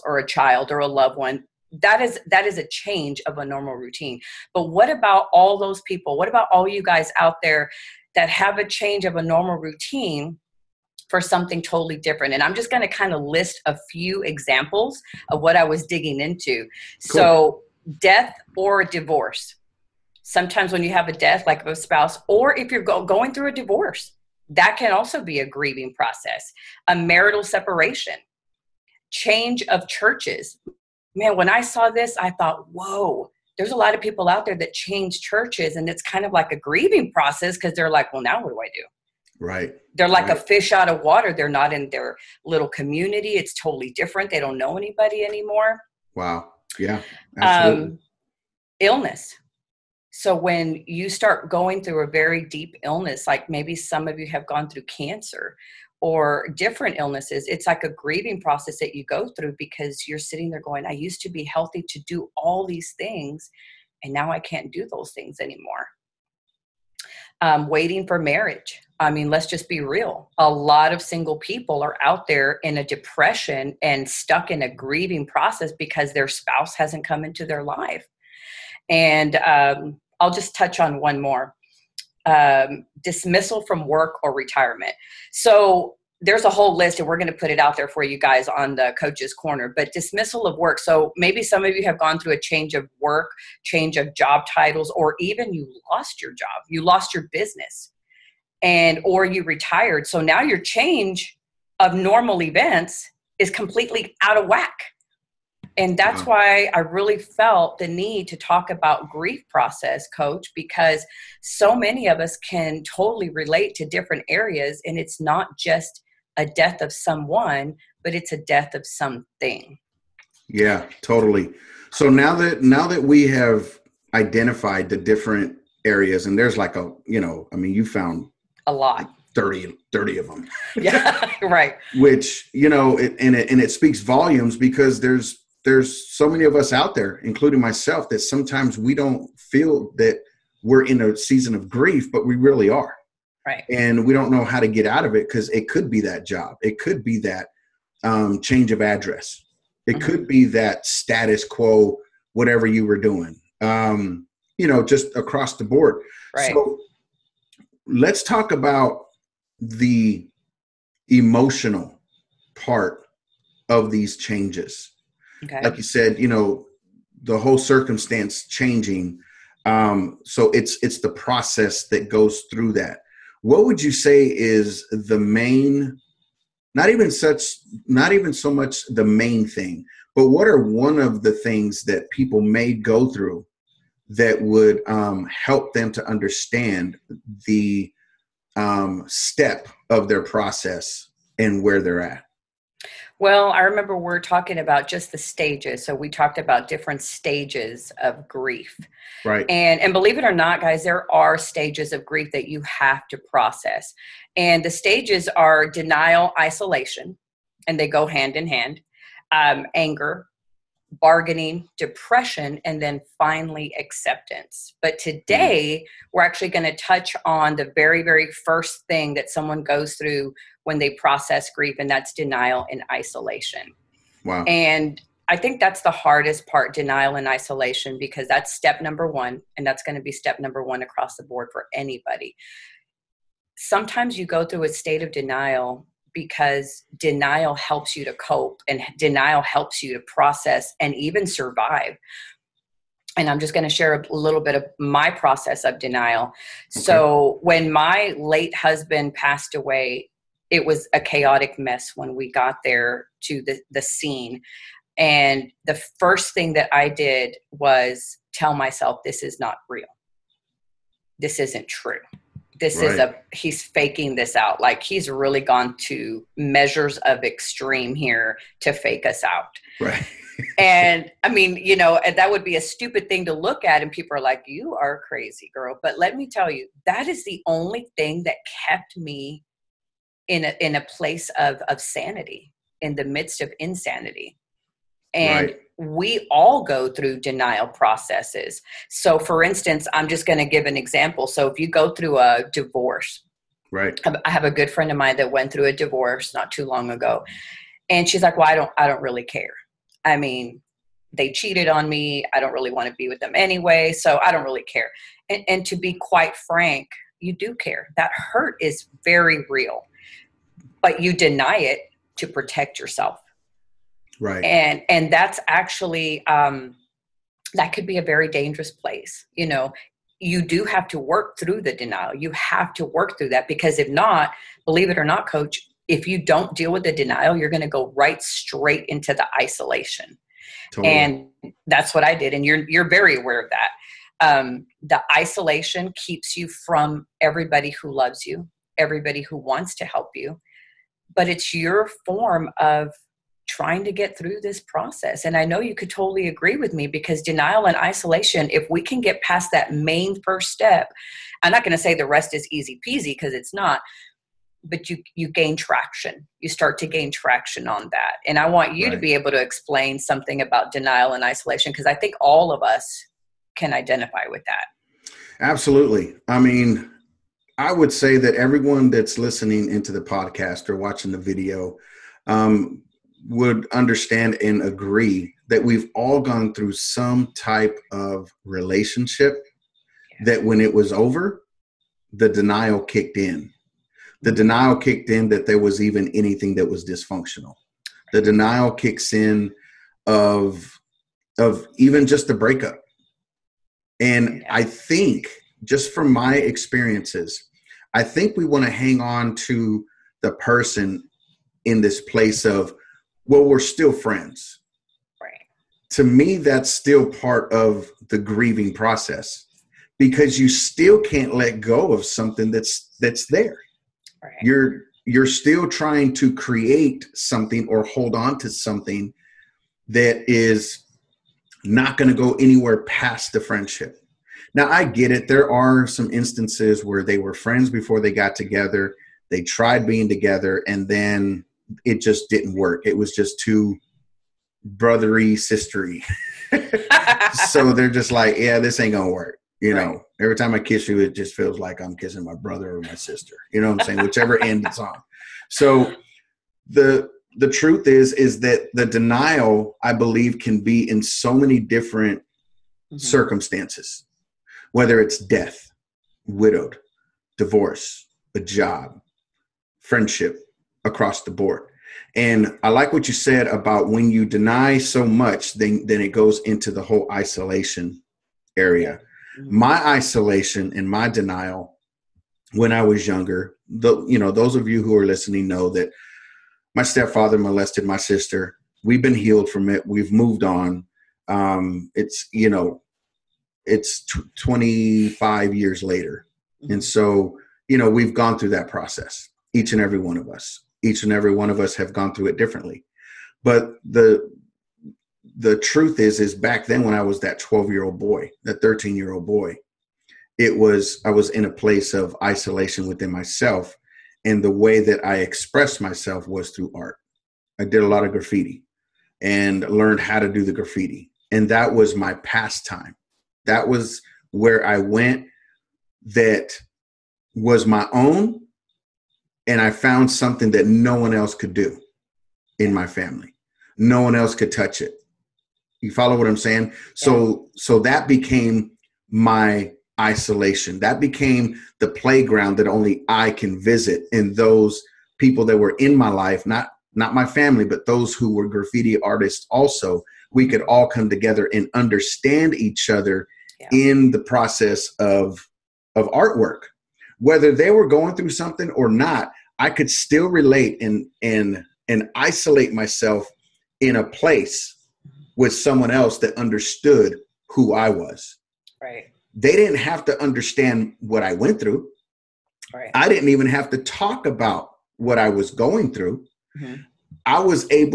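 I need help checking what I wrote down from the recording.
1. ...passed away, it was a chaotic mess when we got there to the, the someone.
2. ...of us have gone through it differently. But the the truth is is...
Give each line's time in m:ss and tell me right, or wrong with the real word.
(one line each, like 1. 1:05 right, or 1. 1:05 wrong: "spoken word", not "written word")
1. 4:09 wrong: "scene", not "someone"
2. 8:11 right.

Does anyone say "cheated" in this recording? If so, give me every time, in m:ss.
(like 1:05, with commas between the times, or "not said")
5:01.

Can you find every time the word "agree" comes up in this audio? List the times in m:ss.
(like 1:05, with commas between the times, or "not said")
5:46, 6:14.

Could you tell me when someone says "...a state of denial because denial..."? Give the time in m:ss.
3:54.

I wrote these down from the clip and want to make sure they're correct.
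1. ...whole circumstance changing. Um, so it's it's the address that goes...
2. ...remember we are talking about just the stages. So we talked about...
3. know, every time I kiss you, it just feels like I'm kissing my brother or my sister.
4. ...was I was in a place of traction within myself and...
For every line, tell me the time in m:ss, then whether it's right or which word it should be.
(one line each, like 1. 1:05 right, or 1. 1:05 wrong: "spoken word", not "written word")
1. 2:47 wrong: "process", not "address"
2. 3:13 right
3. 7:19 right
4. 8:20 wrong: "isolation", not "traction".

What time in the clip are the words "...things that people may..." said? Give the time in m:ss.
3:01.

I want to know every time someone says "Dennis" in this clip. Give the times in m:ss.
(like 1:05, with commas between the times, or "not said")
not said.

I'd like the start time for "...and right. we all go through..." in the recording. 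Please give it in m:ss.
4:45.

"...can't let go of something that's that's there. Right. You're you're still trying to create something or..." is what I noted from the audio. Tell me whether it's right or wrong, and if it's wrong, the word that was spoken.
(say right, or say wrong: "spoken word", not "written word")
right.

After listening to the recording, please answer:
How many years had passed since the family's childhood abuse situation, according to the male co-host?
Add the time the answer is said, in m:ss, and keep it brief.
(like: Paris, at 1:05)
25, at 8:04.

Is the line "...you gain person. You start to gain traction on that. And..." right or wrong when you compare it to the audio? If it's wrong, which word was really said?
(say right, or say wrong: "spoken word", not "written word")
wrong: "traction", not "person".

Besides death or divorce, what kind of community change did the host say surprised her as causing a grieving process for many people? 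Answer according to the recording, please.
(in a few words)
Change of churches.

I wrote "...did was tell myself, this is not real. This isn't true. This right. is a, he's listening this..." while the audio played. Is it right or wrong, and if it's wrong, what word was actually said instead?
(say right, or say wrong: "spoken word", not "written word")
wrong: "faking", not "listening".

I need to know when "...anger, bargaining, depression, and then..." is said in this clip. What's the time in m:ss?
3:29.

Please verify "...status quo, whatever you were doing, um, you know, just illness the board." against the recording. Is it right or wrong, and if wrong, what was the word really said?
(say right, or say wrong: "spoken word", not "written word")
wrong: "across", not "illness".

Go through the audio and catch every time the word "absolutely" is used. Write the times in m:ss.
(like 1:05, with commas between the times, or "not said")
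0:47, 6:05.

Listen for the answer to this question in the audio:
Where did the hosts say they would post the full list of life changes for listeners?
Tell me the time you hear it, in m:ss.
1:28.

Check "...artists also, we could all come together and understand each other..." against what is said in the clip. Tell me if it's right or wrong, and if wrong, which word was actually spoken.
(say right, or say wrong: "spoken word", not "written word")
right.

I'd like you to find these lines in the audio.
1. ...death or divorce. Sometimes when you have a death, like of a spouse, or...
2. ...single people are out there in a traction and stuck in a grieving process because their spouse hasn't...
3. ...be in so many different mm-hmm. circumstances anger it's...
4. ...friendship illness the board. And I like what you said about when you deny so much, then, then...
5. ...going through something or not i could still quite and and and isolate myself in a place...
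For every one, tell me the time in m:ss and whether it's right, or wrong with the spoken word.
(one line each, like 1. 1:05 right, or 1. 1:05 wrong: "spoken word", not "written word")
1. 0:18 right
2. 1:11 wrong: "depression", not "traction"
3. 7:30 wrong: "whether", not "anger"
4. 7:39 wrong: "across", not "illness"
5. 9:07 wrong: "relate", not "quite".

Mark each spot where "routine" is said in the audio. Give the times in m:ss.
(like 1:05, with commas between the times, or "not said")
0:03, 0:09.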